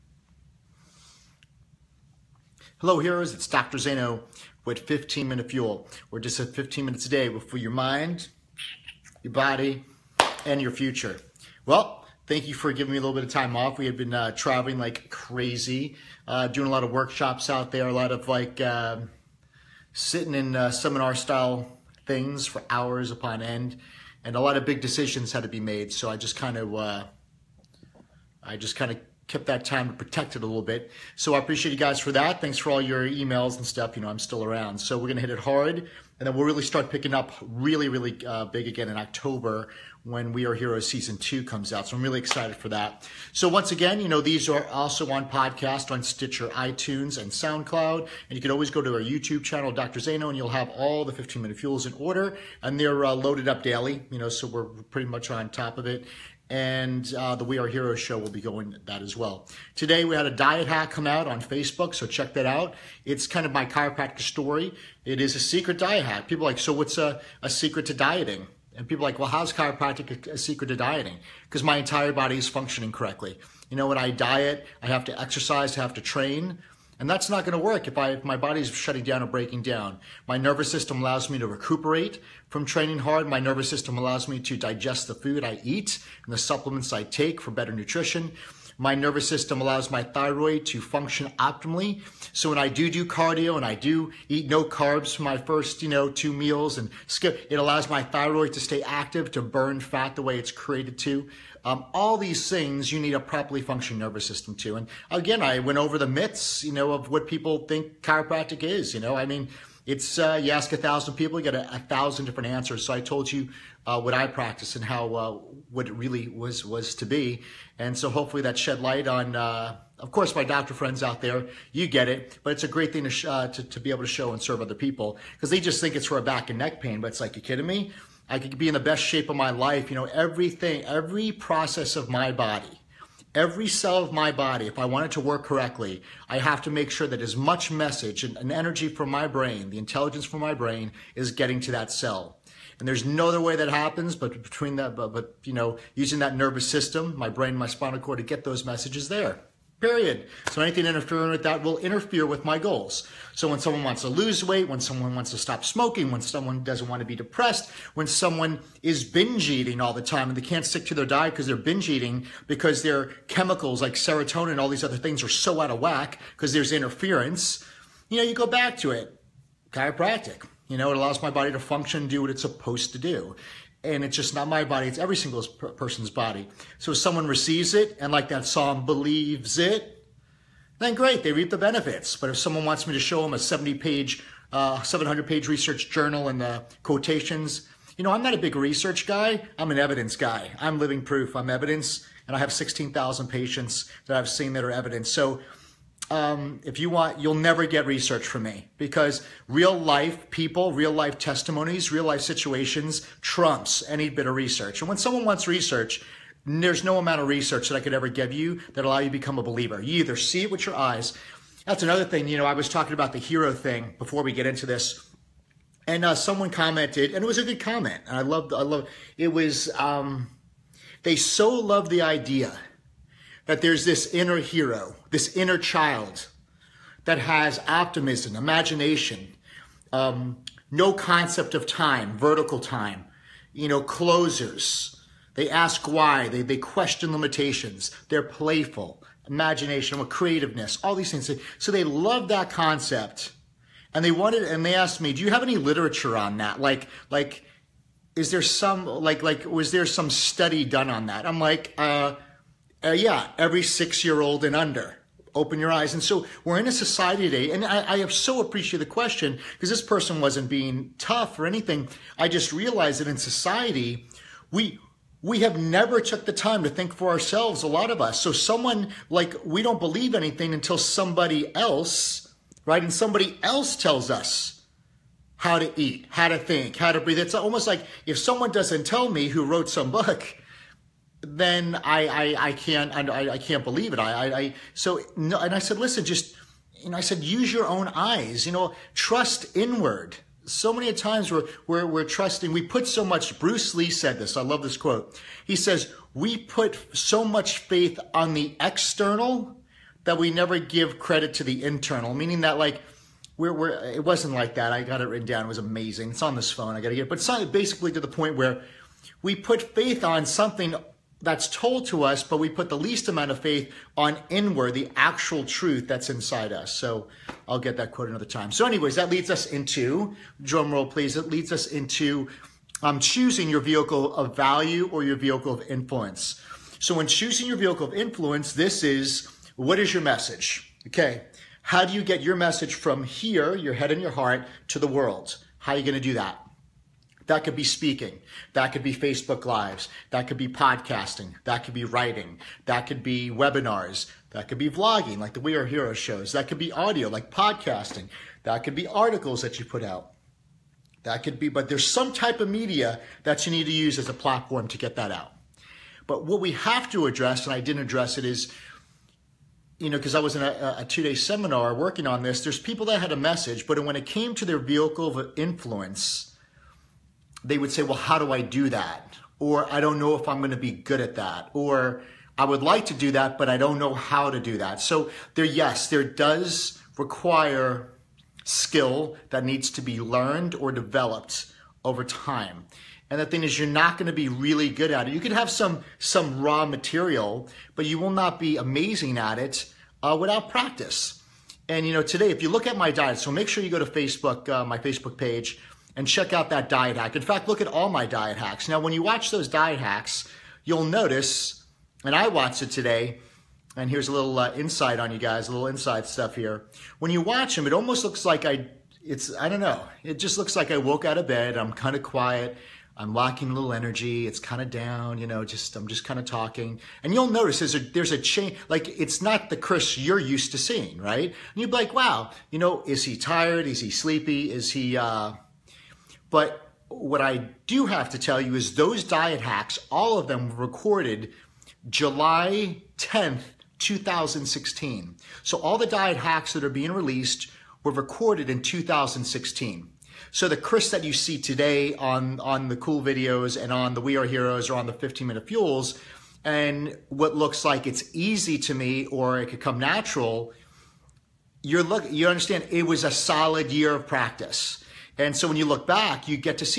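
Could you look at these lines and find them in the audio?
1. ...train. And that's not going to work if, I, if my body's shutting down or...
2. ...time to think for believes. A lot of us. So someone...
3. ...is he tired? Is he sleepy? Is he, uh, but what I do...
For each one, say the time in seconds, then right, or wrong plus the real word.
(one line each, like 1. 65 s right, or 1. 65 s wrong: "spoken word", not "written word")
1. 76 s right
2. 266 s wrong: "ourselves", not "believes"
3. 422 s right.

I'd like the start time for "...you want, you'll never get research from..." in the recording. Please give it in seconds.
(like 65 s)
196 s.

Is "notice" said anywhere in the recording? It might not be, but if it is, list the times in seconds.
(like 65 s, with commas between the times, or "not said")
400 s, 417 s.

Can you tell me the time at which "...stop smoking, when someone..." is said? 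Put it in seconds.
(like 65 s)
155 s.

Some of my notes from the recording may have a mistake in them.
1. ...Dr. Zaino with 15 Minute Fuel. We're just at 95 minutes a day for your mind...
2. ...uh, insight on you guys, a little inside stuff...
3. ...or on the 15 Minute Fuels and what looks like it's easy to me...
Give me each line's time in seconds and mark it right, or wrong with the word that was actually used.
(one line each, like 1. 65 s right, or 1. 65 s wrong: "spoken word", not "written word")
1. 3 s wrong: "15", not "95"
2. 404 s right
3. 444 s right.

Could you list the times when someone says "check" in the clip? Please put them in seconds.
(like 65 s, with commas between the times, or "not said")
62 s, 396 s.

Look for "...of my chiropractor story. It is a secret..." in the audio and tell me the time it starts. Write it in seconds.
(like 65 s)
63 s.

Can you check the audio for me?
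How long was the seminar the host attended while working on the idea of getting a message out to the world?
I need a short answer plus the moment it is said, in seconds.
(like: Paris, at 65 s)
two day, at 360 s.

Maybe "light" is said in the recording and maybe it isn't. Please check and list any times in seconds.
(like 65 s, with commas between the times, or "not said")
118 s.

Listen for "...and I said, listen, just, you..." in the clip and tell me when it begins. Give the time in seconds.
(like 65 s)
285 s.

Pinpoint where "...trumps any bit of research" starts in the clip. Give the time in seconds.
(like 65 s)
203 s.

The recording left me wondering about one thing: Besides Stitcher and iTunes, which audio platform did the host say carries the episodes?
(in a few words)
SoundCloud.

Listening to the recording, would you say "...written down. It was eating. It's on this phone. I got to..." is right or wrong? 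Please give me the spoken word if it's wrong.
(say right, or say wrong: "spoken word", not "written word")
wrong: "amazing", not "eating".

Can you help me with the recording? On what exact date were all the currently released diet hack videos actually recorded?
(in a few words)
July 10th, 2016.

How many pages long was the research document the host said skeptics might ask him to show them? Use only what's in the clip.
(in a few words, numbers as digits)
700.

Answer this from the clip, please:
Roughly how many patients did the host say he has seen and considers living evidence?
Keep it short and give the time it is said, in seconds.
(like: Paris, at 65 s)
16000, at 192 s.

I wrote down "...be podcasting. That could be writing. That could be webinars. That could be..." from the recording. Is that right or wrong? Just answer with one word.
right.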